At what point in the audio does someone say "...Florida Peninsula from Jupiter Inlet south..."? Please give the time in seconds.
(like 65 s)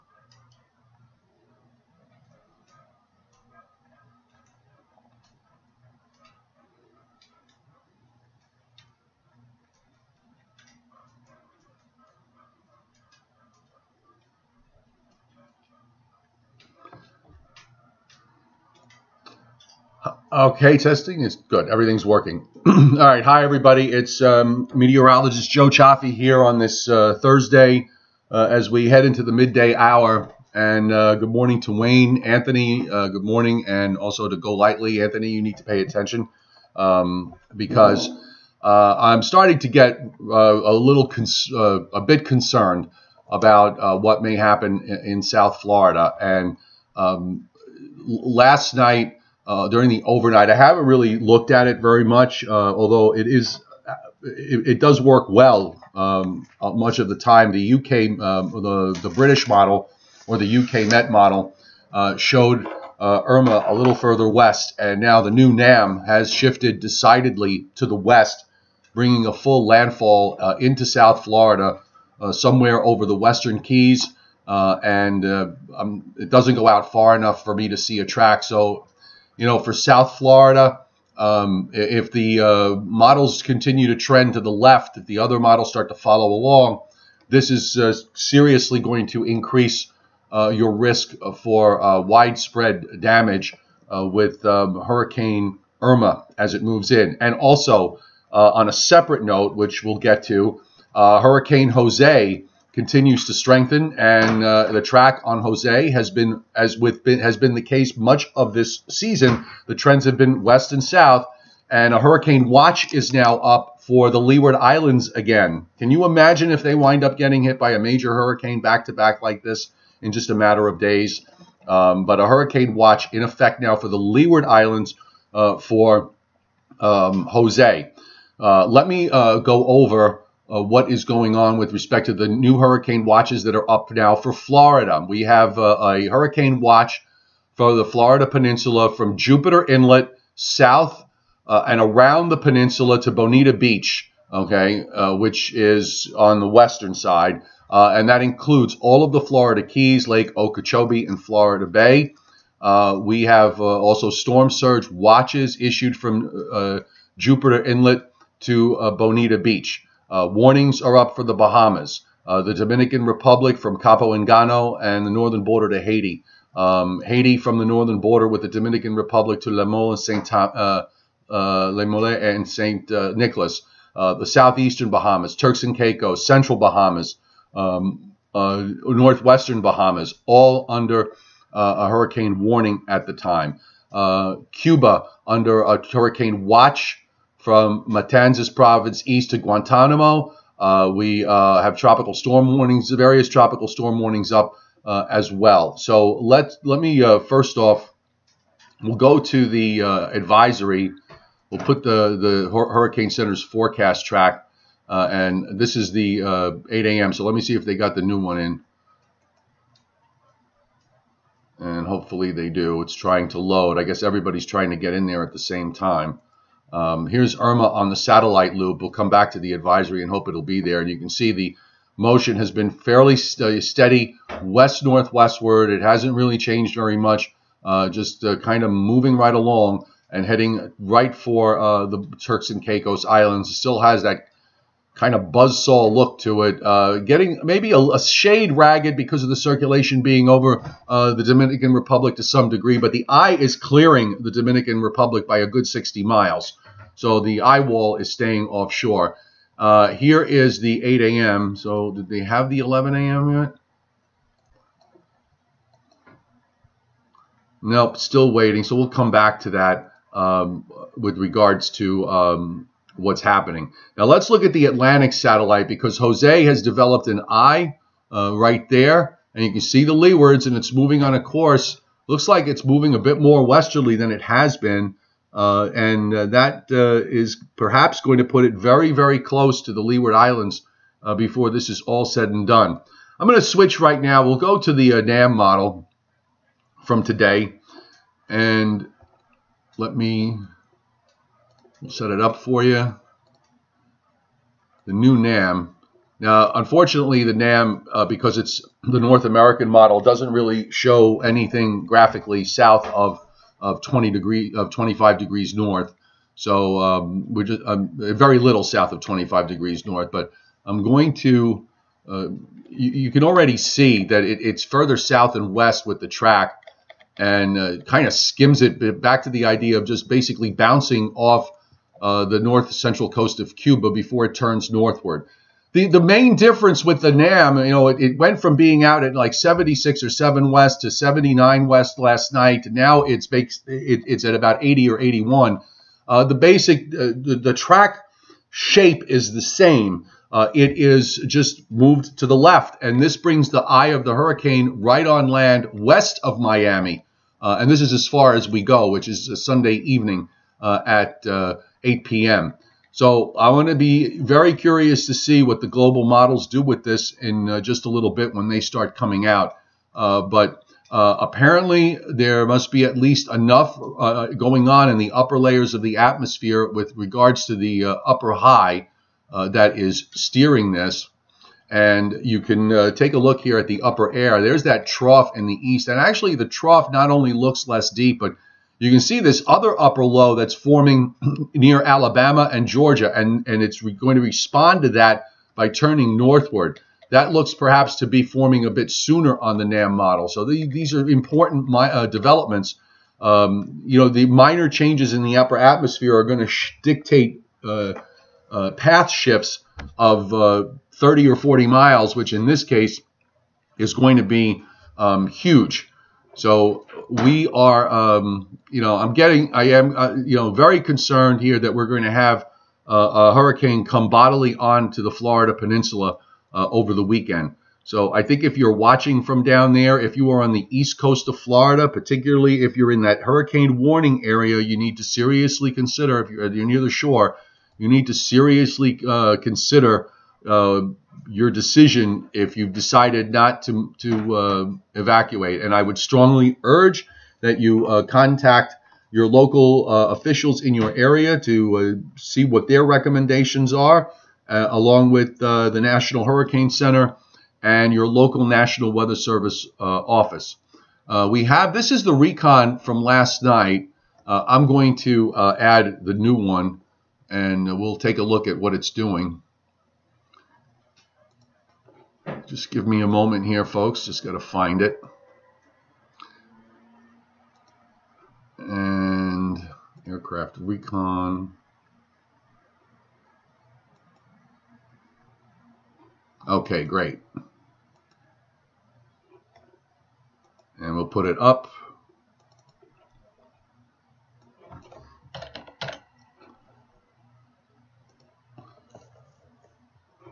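137 s.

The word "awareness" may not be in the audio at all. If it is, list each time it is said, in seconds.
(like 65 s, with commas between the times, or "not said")
not said.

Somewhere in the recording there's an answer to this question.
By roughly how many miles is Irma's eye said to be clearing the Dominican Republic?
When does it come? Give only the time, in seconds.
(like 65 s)
245 s.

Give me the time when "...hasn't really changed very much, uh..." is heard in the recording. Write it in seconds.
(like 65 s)
225 s.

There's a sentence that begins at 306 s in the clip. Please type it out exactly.
So um, we're just um, very little south of 25 degrees north.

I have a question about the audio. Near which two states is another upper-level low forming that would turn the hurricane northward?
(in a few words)
Alabama and Georgia.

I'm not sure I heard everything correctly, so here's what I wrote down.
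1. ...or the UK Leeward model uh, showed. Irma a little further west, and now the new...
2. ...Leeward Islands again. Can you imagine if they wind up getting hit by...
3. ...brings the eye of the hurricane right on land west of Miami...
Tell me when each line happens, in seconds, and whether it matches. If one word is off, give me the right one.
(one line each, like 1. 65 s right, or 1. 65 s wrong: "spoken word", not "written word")
1. 60 s wrong: "Met", not "Leeward"
2. 114 s right
3. 343 s right.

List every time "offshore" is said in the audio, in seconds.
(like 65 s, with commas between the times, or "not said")
248 s.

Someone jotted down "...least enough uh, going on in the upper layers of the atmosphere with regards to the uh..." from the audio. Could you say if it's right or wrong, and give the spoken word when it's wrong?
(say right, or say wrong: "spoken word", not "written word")
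right.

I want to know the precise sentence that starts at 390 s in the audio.
So the, these are important uh, developments.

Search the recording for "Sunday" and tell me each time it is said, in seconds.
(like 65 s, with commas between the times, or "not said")
349 s.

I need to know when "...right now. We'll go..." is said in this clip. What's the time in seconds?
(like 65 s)
283 s.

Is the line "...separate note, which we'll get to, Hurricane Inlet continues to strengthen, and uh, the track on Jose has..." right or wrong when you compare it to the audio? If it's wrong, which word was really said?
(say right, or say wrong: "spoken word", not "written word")
wrong: "Jose", not "Inlet".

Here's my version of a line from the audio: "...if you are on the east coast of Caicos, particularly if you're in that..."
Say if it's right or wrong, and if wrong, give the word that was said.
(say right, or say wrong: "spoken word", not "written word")
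wrong: "Florida", not "Caicos".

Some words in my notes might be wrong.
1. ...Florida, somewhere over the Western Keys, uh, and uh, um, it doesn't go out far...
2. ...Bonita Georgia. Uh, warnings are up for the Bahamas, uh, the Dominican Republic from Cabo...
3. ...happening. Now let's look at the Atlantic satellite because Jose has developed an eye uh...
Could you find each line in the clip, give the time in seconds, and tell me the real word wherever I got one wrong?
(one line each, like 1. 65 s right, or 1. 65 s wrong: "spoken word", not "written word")
1. 71 s right
2. 158 s wrong: "Beach", not "Georgia"
3. 263 s right.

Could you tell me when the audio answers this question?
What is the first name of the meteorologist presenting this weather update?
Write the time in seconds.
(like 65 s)
25 s.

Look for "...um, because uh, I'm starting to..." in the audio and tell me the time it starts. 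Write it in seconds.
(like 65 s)
36 s.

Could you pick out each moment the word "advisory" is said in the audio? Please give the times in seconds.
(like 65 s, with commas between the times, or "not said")
200 s, 219 s.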